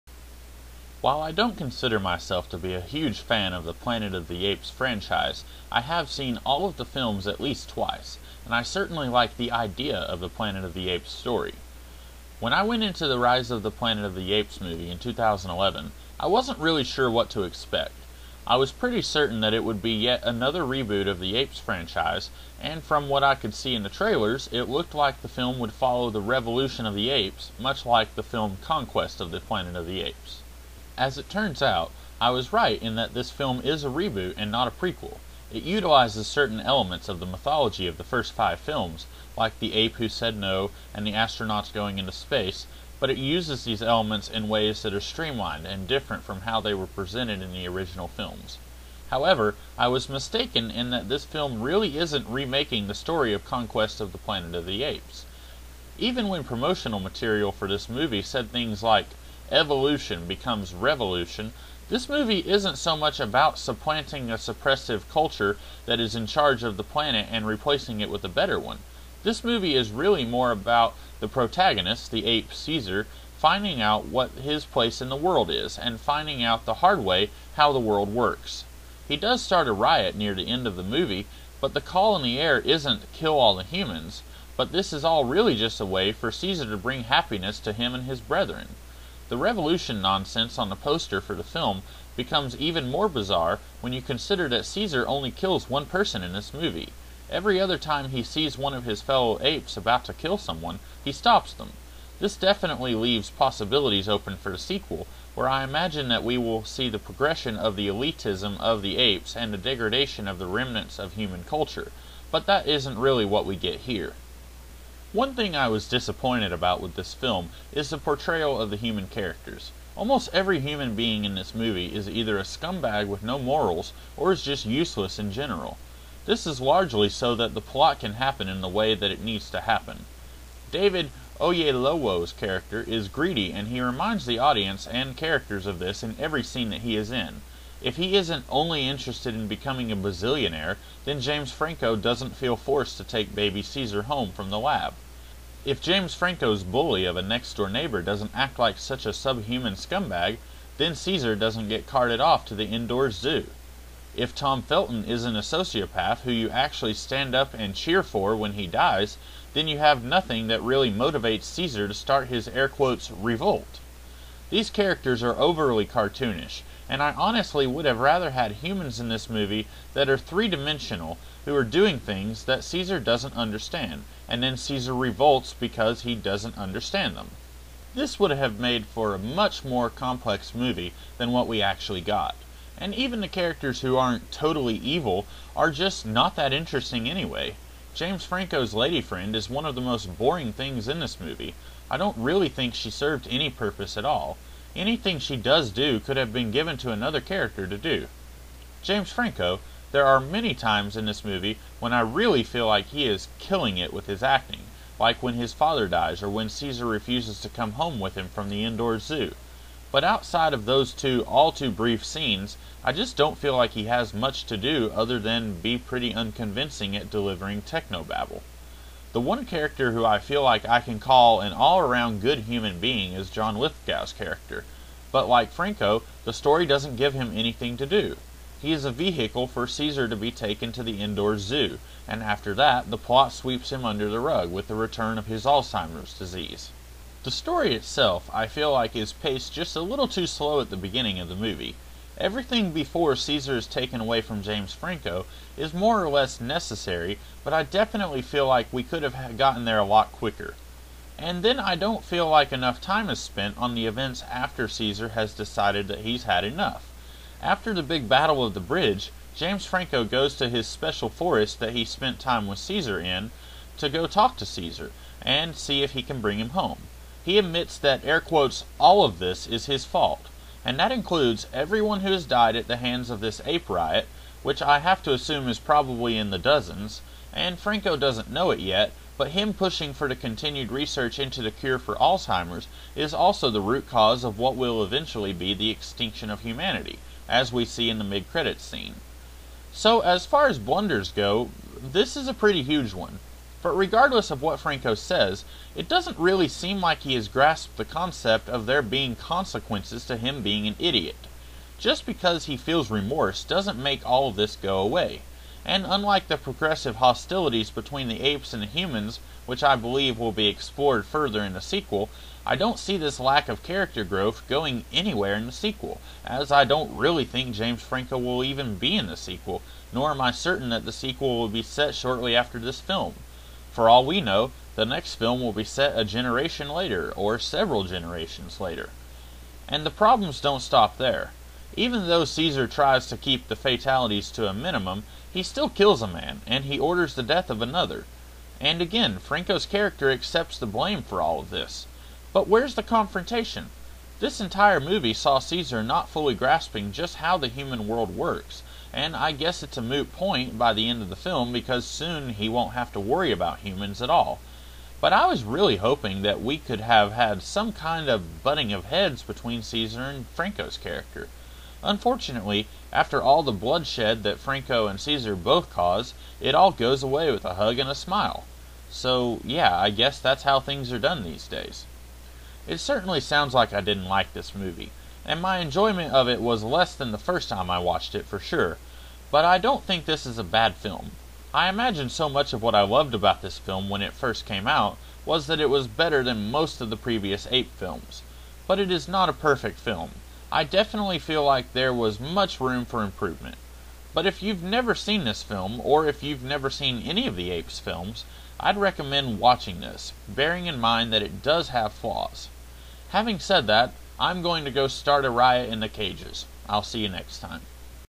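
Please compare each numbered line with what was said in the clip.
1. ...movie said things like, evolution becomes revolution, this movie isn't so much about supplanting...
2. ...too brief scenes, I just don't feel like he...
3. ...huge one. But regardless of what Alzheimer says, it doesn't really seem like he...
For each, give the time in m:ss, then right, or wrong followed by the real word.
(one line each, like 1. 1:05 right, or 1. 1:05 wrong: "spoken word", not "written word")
1. 0:57 right
2. 3:31 right
3. 4:52 wrong: "Franco", not "Alzheimer".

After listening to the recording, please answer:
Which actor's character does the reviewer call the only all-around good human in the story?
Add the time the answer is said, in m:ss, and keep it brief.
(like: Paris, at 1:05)
John Lithgow, at 3:43.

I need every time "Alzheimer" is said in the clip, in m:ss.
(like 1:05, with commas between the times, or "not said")
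3:55, 4:41.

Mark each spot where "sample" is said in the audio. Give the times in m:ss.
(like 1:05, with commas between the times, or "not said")
not said.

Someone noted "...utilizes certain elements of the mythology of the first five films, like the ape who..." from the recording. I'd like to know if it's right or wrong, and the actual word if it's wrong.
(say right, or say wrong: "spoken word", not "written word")
right.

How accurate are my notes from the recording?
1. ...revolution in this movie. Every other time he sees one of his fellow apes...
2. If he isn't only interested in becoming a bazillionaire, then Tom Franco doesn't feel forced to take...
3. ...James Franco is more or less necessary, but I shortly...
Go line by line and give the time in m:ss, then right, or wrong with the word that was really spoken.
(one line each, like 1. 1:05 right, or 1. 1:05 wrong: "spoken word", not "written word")
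1. 1:35 wrong: "person", not "revolution"
2. 2:17 wrong: "James", not "Tom"
3. 4:04 wrong: "definitely", not "shortly".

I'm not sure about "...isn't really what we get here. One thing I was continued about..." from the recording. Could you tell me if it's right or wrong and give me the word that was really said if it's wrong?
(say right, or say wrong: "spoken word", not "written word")
wrong: "disappointed", not "continued".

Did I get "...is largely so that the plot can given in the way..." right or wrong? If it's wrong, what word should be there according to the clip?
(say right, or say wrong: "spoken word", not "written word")
wrong: "happen", not "given".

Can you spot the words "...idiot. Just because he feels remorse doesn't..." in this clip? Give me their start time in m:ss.
5:00.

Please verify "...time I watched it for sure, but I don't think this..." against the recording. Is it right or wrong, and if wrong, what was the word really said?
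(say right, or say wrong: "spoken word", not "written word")
right.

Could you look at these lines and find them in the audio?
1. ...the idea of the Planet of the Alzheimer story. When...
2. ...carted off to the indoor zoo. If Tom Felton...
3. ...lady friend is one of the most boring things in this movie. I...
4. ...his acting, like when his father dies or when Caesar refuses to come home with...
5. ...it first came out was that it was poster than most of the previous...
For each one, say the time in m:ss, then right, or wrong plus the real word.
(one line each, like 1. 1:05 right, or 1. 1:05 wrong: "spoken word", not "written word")
1. 0:09 wrong: "Apes", not "Alzheimer"
2. 2:31 right
3. 3:08 right
4. 3:24 right
5. 6:24 wrong: "better", not "poster".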